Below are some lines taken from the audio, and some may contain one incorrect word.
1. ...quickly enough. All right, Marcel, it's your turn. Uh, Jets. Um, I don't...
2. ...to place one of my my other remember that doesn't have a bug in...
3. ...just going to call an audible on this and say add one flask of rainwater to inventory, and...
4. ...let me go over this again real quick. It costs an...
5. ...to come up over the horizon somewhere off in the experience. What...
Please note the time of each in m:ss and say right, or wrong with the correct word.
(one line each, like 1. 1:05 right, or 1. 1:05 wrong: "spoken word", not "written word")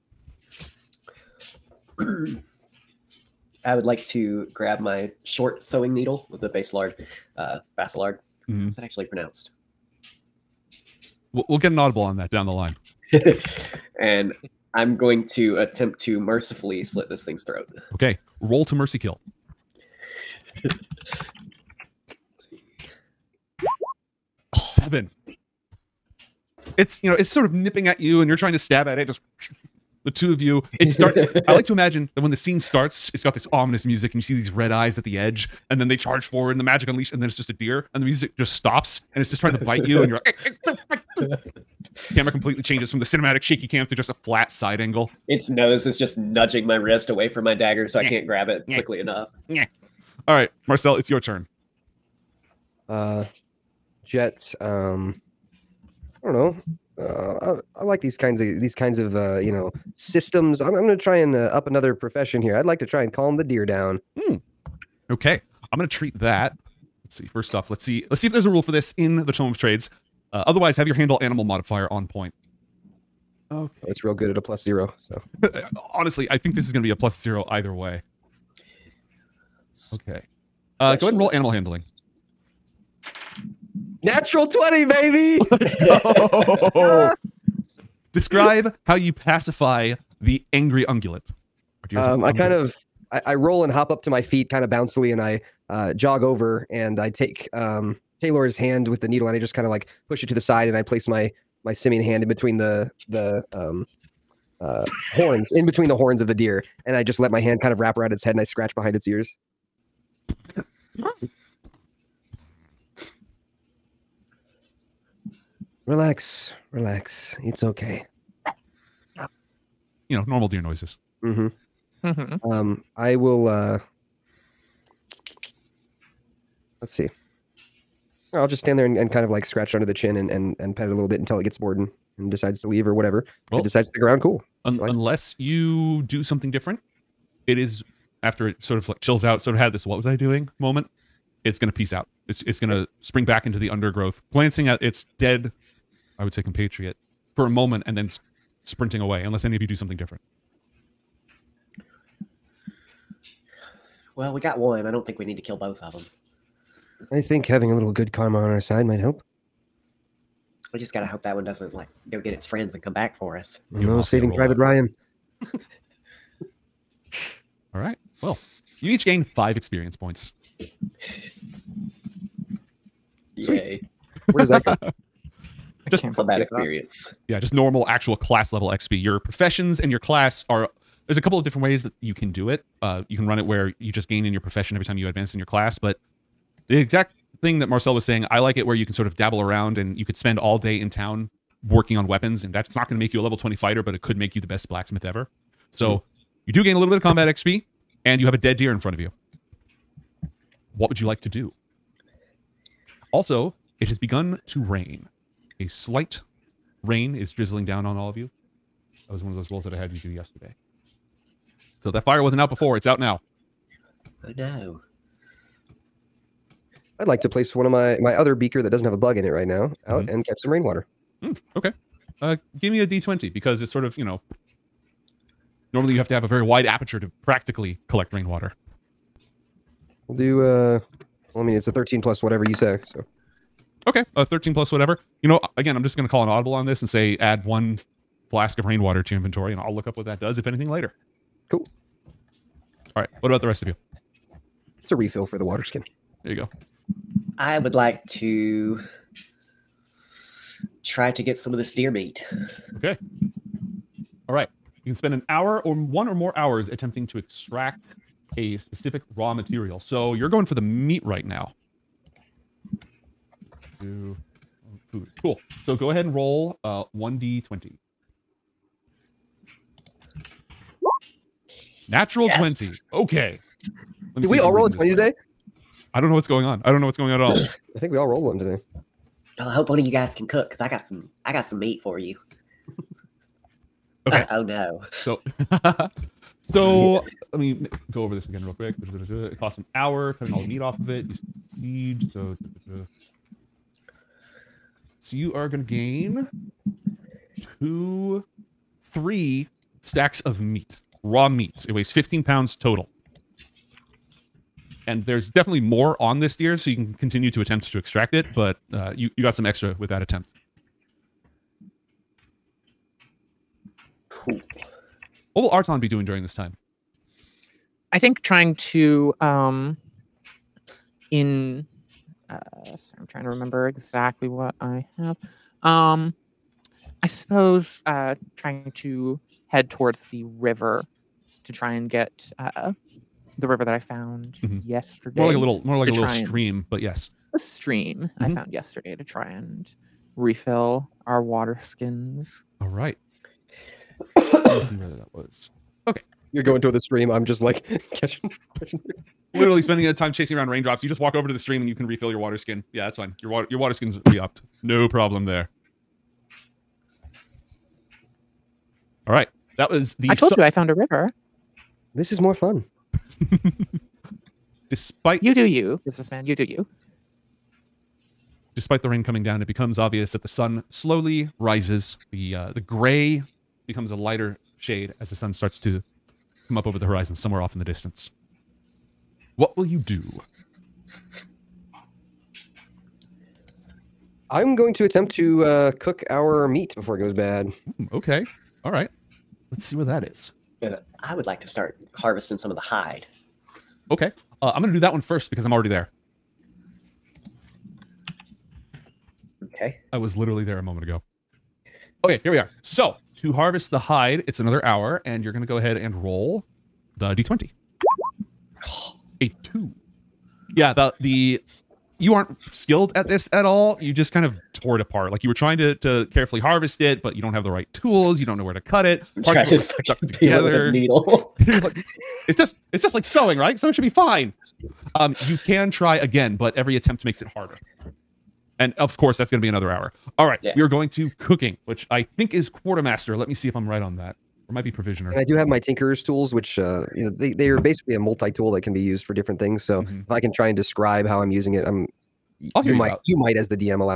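1. 0:48 right
2. 3:37 wrong: "beaker", not "remember"
3. 3:55 right
4. 4:47 right
5. 6:15 wrong: "distance", not "experience".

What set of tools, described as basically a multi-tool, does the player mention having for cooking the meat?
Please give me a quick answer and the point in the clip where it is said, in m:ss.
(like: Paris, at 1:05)
Tinkerer's tools, at 7:15.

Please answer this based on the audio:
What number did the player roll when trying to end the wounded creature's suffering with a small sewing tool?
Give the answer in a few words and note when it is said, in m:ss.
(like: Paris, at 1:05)
7, at 0:24.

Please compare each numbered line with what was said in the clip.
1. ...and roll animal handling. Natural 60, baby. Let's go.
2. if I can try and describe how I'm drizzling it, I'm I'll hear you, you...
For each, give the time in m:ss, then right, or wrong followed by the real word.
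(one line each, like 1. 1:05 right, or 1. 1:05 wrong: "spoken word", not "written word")
1. 1:21 wrong: "20", not "60"
2. 7:20 wrong: "using", not "drizzling".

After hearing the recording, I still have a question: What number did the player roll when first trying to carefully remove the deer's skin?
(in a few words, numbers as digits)
2.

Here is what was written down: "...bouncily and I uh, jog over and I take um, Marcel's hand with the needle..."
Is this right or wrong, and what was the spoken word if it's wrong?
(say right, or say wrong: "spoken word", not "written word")
wrong: "Taylor", not "Marcel".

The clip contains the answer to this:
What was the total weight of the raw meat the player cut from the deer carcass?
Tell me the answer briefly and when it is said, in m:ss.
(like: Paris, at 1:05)
15 pounds, at 5:01.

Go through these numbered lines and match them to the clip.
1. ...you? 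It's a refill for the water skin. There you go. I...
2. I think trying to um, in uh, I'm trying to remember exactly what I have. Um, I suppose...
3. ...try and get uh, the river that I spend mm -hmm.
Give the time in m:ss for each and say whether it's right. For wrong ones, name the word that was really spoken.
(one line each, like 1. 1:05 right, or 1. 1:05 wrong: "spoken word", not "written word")
1. 4:03 right
2. 5:17 right
3. 5:31 wrong: "found", not "spend".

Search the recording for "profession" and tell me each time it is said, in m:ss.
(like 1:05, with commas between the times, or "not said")
1:01, 2:59, 3:04.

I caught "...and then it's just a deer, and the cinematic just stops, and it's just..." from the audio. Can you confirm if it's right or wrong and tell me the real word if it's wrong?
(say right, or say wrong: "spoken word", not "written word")
wrong: "music", not "cinematic".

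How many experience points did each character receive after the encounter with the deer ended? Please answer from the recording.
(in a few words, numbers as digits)
5.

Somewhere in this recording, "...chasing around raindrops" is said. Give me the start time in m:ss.
5:50.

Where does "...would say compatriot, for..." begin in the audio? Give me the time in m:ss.
2:26.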